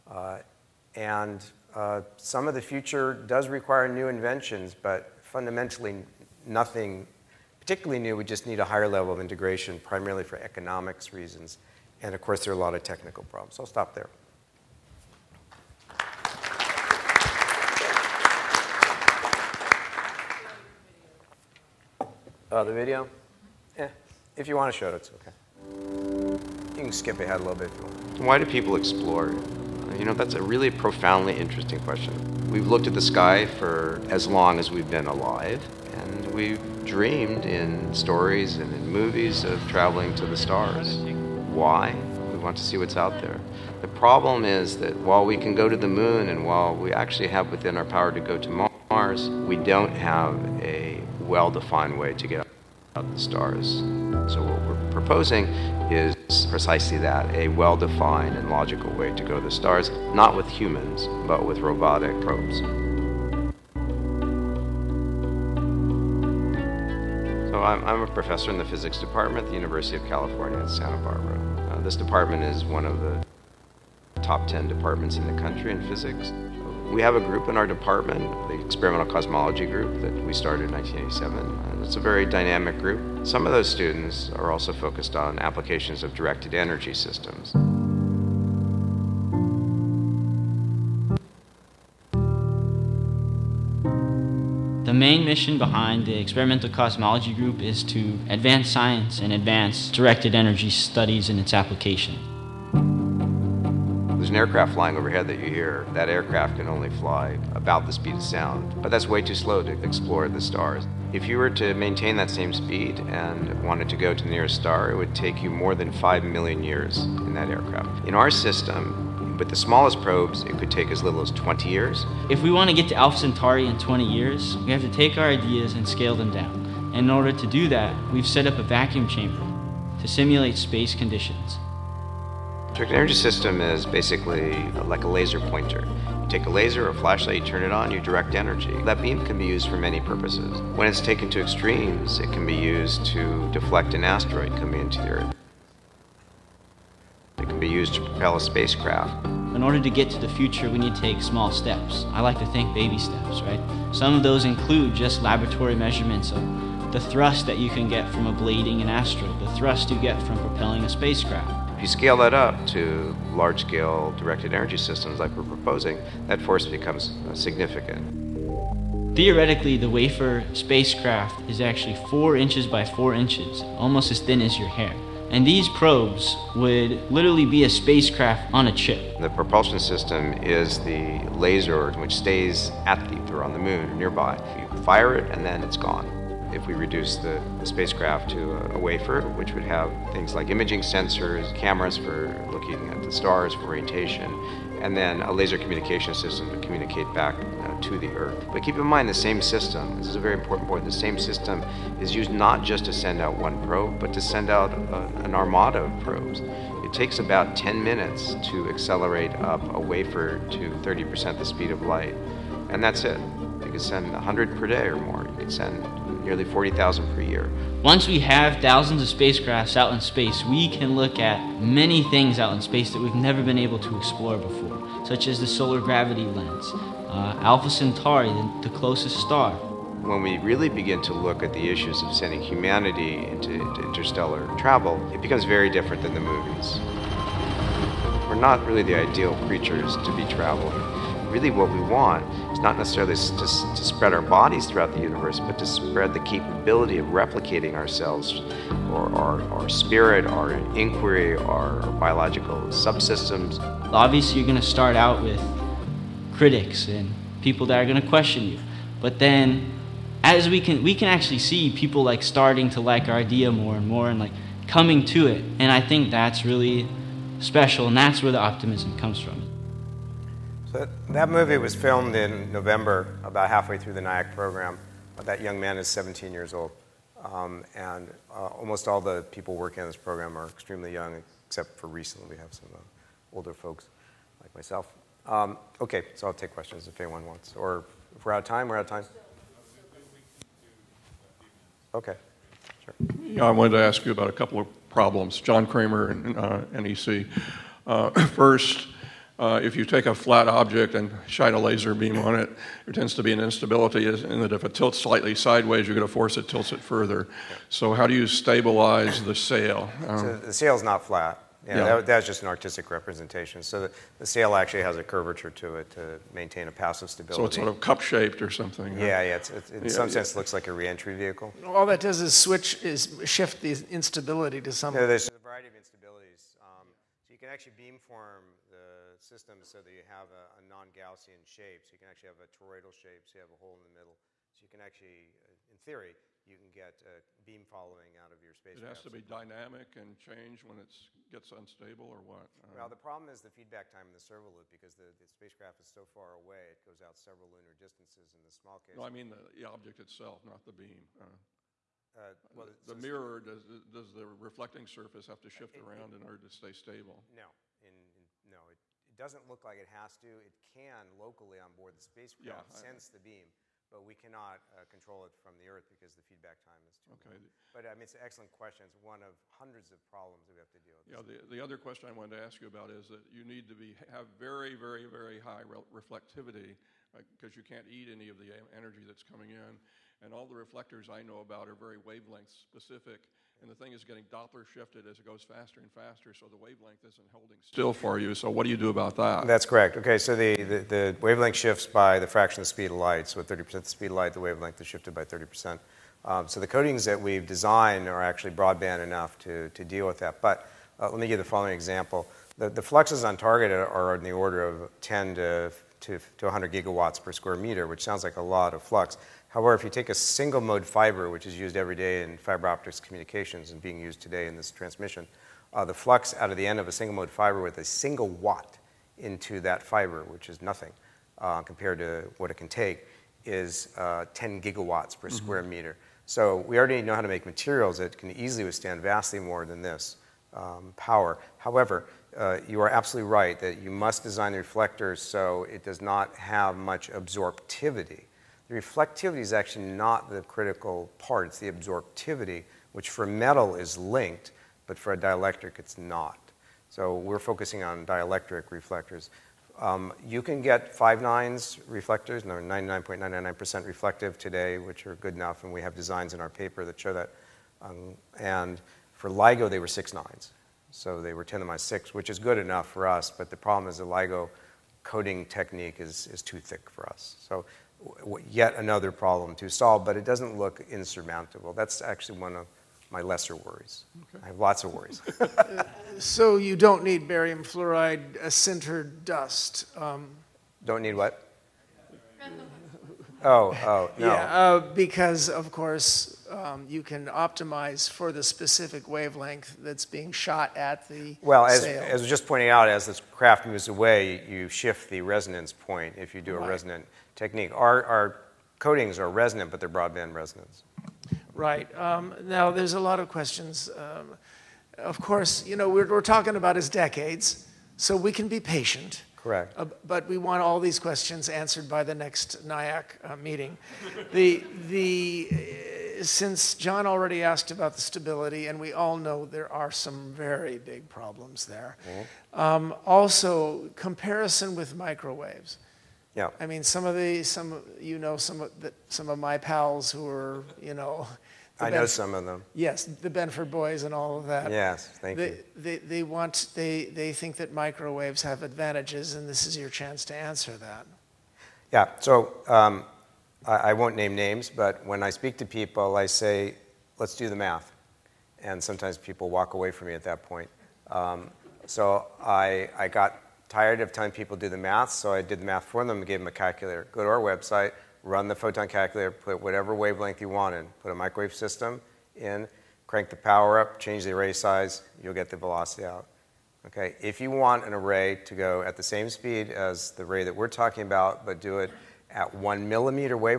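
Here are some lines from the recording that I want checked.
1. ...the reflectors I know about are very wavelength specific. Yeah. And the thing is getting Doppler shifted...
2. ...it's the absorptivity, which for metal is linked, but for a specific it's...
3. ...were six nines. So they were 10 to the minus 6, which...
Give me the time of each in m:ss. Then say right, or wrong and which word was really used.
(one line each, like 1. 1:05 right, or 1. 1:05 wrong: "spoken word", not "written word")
1. 6:20 right
2. 7:21 wrong: "dielectric", not "specific"
3. 7:39 right.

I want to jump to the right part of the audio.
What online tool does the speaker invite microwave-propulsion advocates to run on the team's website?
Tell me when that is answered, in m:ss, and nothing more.
9:18.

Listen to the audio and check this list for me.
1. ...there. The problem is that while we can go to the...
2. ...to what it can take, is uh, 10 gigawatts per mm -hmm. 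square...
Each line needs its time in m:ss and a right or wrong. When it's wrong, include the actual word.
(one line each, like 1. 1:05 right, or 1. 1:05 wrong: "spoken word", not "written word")
1. 0:43 right
2. 7:01 right.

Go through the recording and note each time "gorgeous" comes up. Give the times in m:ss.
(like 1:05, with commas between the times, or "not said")
not said.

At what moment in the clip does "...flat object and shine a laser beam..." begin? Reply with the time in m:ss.
5:00.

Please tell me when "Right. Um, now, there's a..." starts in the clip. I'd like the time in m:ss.
8:21.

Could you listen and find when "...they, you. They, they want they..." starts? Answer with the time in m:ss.
8:55.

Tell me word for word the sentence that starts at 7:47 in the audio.
So yet another problem to solve, but it doesn't look insurmountable.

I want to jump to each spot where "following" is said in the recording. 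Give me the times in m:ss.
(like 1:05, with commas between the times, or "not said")
5:37, 6:41.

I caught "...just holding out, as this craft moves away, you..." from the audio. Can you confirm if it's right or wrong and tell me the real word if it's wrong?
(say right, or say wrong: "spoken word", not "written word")
wrong: "pointing", not "holding".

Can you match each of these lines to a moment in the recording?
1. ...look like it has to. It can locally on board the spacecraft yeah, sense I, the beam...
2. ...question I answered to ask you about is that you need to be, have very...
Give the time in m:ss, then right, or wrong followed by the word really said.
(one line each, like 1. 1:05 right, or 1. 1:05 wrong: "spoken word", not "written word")
1. 5:59 right
2. 6:11 wrong: "wanted", not "answered".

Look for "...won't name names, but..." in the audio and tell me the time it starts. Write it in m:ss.
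9:03.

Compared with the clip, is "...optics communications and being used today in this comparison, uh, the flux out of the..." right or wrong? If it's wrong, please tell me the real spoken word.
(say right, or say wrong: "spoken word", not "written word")
wrong: "transmission", not "comparison".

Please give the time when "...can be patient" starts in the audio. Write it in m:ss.
8:28.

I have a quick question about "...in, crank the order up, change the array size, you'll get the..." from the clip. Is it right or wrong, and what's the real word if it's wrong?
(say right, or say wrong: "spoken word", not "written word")
wrong: "power", not "order".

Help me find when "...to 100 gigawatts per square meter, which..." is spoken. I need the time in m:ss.
6:46.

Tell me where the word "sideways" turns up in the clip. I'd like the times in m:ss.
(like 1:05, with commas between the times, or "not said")
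5:05.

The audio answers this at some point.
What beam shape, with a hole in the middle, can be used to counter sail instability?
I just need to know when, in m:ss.
5:32.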